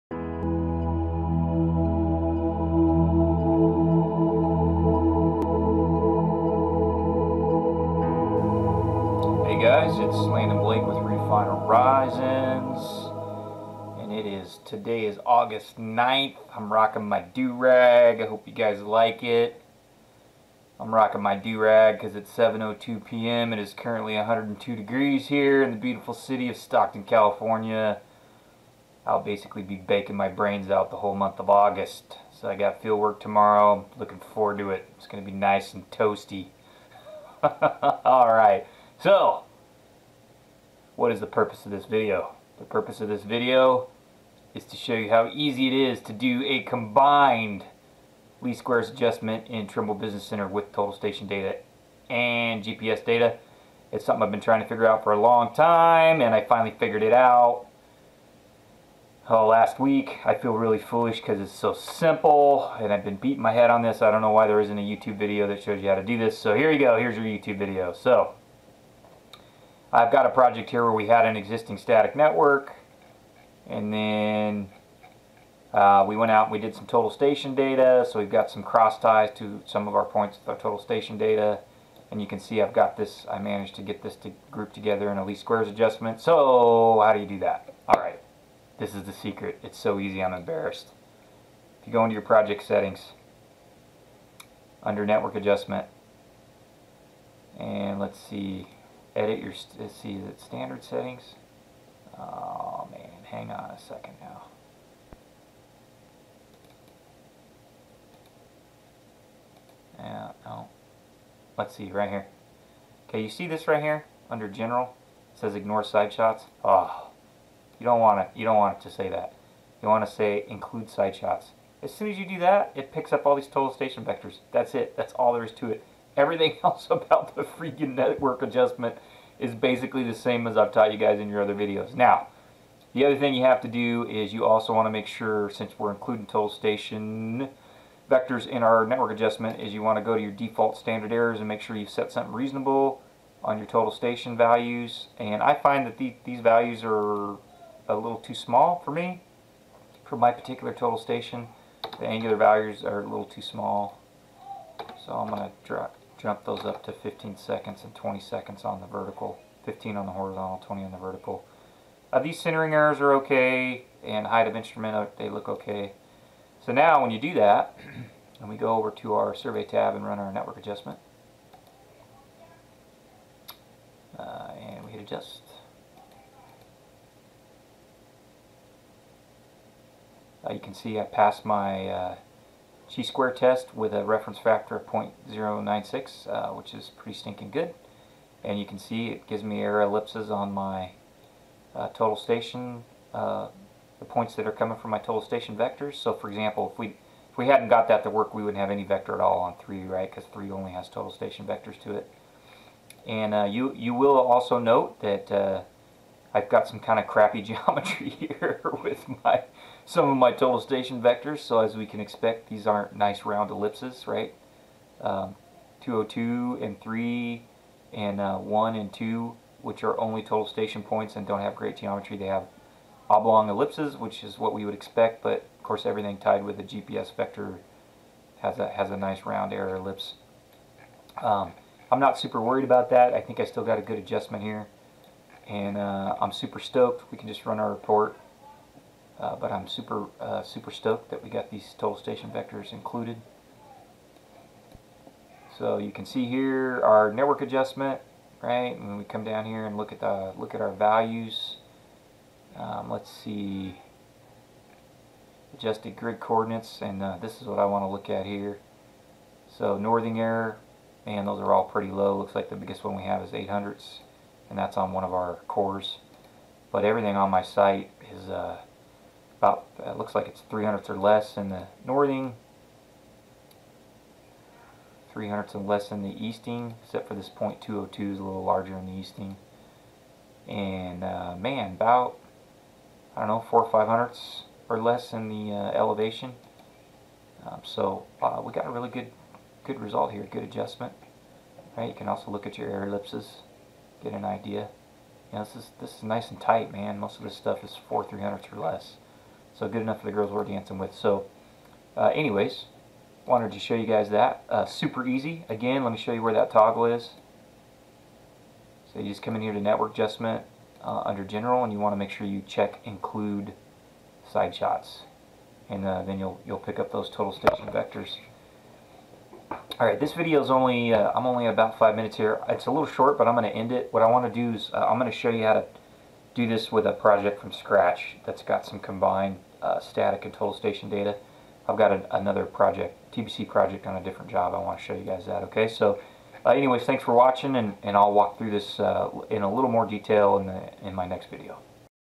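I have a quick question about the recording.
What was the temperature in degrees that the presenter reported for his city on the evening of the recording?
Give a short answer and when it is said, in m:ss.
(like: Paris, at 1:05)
102, at 0:24.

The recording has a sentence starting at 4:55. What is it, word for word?
You know, this is this is nice and tight, man.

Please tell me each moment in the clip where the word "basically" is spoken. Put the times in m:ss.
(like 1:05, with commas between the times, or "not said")
0:29, 2:09.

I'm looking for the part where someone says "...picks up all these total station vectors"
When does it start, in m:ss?
2:02.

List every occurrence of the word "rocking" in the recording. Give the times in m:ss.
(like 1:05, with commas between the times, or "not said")
0:16, 0:20.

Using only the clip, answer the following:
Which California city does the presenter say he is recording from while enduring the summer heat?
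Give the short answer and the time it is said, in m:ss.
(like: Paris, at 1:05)
Stockton, at 0:26.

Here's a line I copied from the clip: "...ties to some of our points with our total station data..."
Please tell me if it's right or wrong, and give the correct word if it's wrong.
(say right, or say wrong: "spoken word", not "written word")
right.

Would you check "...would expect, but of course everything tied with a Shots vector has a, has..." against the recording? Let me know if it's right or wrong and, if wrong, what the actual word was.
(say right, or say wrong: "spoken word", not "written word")
wrong: "GPS", not "Shots".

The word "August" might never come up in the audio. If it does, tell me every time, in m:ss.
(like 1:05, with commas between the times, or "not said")
0:15, 0:31.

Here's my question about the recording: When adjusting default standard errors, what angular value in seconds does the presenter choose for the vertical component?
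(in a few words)
20.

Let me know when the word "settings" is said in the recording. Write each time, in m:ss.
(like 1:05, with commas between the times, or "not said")
1:32, 1:40.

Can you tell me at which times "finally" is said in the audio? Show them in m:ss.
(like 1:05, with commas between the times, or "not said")
0:56.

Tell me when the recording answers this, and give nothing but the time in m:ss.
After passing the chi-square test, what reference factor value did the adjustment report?
3:04.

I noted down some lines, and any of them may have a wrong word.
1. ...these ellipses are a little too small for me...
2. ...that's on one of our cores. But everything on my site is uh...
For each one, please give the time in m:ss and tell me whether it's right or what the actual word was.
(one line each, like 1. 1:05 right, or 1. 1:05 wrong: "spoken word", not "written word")
1. 2:26 wrong: "values", not "ellipses"
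2. 4:24 right.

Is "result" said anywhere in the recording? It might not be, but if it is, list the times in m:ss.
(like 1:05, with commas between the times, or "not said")
4:49.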